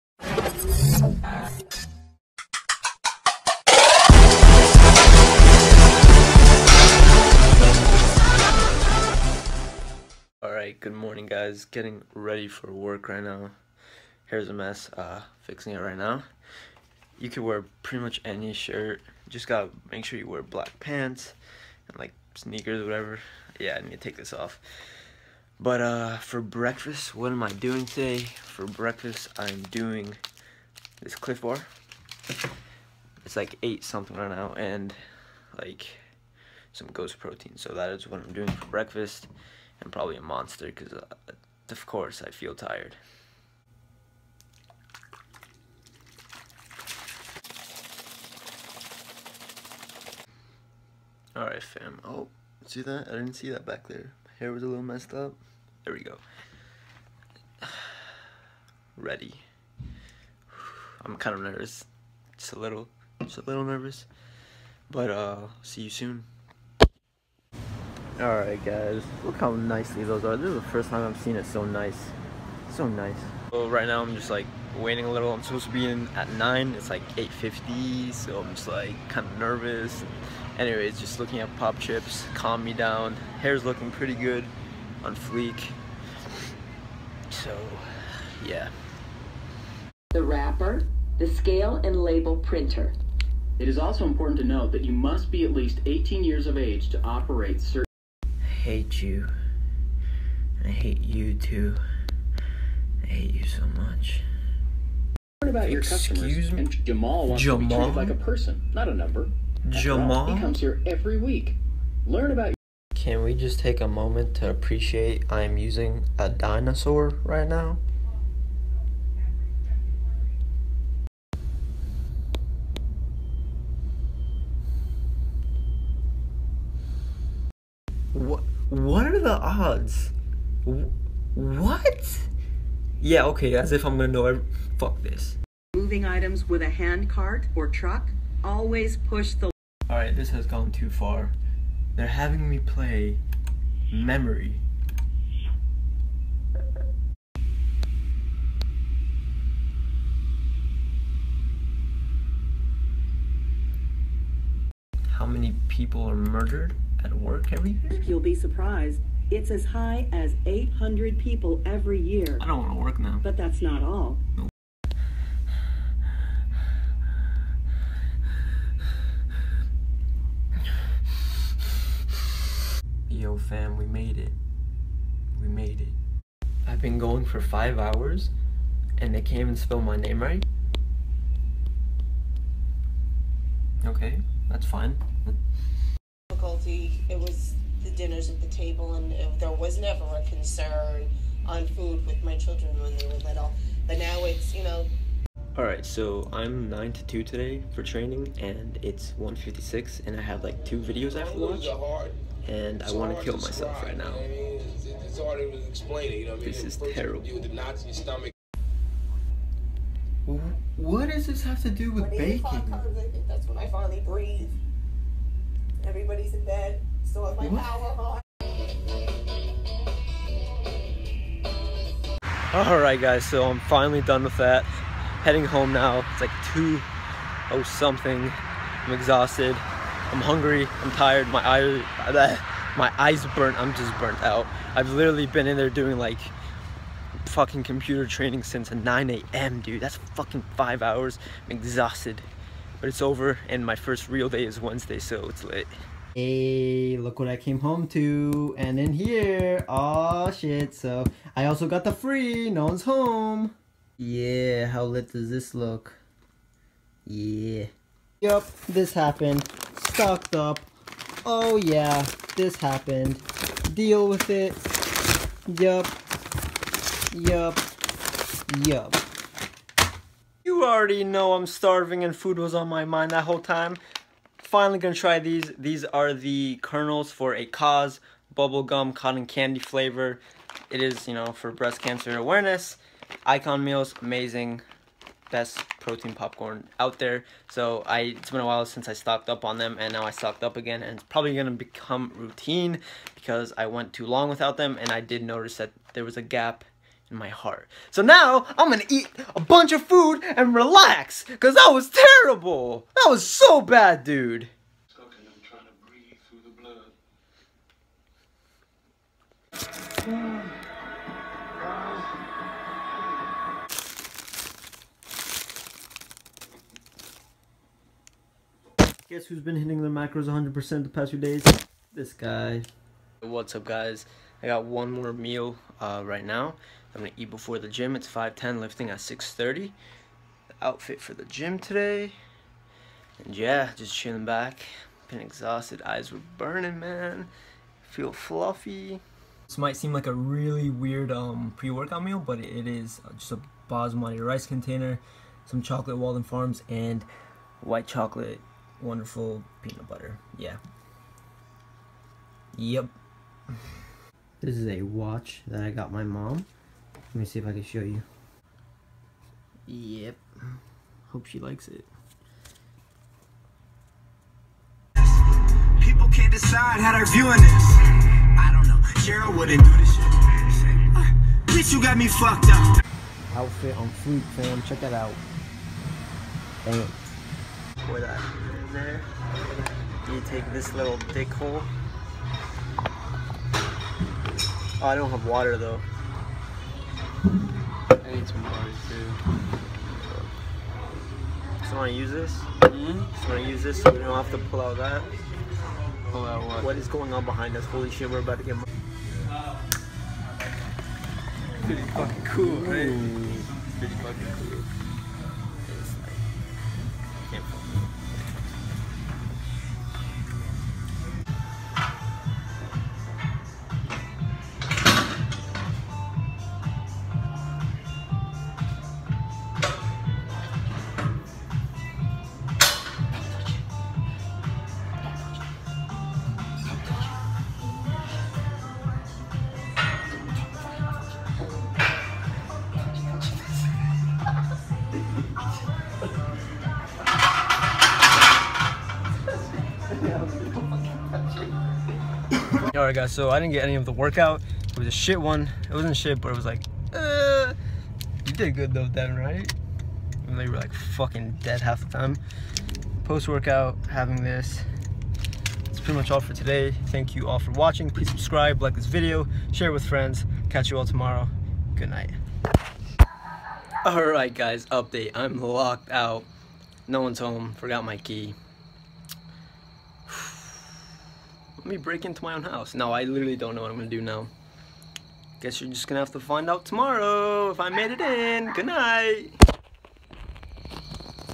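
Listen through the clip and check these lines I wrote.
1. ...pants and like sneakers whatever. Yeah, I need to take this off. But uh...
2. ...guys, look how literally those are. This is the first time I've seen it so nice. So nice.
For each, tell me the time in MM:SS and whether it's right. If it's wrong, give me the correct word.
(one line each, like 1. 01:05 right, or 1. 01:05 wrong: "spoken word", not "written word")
1. 00:20 right
2. 01:08 wrong: "nicely", not "literally".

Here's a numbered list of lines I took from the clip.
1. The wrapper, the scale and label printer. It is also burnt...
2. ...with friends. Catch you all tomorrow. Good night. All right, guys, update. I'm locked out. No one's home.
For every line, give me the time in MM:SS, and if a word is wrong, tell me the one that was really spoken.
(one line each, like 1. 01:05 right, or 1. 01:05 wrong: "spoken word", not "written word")
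1. 01:30 wrong: "important", not "burnt"
2. 07:39 right.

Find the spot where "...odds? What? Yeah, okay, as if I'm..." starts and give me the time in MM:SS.
02:09.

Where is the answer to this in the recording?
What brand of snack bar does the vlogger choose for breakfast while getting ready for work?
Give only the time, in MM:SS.
00:31.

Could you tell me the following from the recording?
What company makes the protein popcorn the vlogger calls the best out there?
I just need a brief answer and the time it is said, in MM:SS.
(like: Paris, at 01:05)
Icon Meals, at 04:43.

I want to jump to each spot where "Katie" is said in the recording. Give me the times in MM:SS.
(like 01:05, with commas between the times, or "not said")
not said.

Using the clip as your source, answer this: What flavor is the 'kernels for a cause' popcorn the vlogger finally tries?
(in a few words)
bubblegum cotton candy.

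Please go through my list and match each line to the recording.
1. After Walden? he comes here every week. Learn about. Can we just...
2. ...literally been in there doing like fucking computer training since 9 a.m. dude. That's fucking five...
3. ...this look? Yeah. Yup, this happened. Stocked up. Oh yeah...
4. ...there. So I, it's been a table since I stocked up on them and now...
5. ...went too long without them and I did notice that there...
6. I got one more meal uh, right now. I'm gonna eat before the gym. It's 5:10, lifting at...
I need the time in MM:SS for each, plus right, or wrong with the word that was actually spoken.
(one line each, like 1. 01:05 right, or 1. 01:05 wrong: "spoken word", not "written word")
1. 01:49 wrong: "Jamal", not "Walden"
2. 03:54 right
3. 04:15 right
4. 04:46 wrong: "while", not "table"
5. 04:53 right
6. 05:24 right.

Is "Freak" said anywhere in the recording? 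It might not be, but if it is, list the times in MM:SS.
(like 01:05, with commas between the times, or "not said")
06:13.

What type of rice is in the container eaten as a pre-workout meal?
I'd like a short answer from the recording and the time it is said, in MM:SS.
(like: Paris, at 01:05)
basmati, at 05:43.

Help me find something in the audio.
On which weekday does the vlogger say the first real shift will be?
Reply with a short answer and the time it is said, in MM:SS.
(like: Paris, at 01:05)
Wednesday, at 04:04.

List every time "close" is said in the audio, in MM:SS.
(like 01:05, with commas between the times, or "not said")
not said.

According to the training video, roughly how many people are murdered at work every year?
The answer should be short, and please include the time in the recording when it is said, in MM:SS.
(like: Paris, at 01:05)
800, at 02:40.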